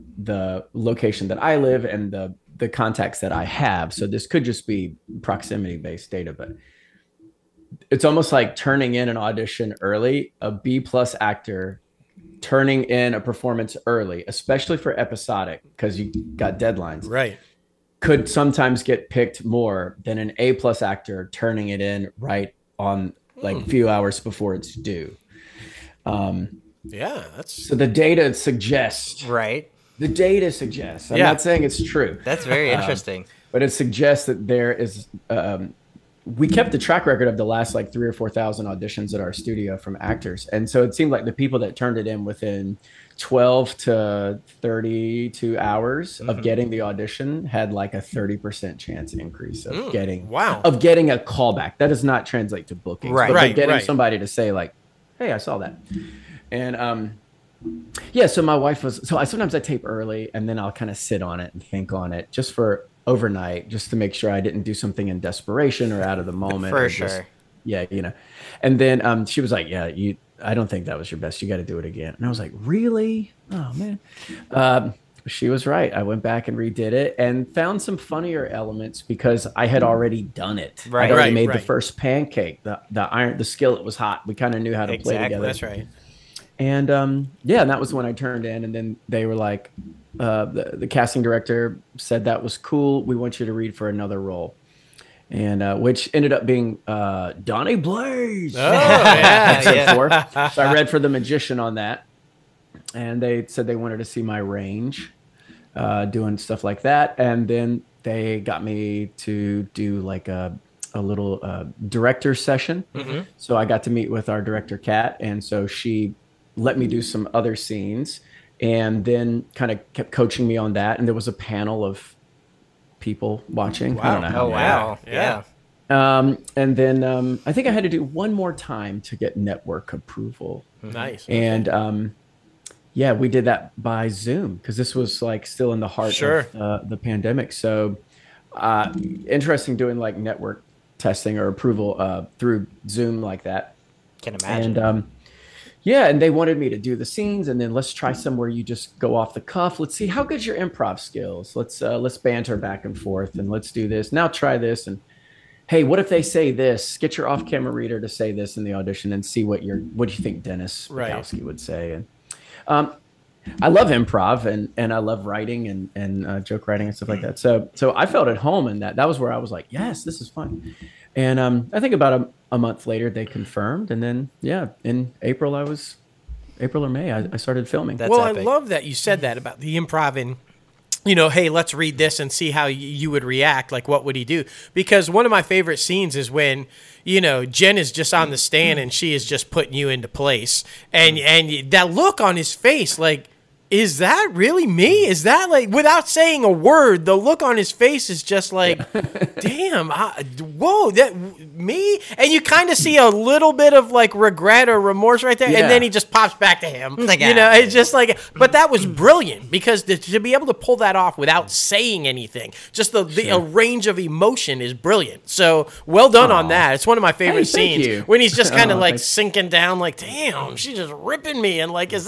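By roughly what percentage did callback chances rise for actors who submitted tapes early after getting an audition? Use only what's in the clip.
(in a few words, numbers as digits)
30%.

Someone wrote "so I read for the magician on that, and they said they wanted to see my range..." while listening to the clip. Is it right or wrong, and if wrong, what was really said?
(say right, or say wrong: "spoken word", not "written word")
right.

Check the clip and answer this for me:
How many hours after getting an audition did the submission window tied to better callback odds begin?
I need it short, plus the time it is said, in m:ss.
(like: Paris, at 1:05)
12, at 0:43.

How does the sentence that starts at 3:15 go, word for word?
Is that like without saying a word?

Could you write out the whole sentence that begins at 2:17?
So uh, interesting doing like network testing or approval uh, through Zoom like that.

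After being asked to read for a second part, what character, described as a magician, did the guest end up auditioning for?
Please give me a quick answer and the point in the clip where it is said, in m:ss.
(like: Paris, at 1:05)
Donnie Blaze, at 1:37.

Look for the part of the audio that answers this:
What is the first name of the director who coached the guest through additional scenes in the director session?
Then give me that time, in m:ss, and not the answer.
1:54.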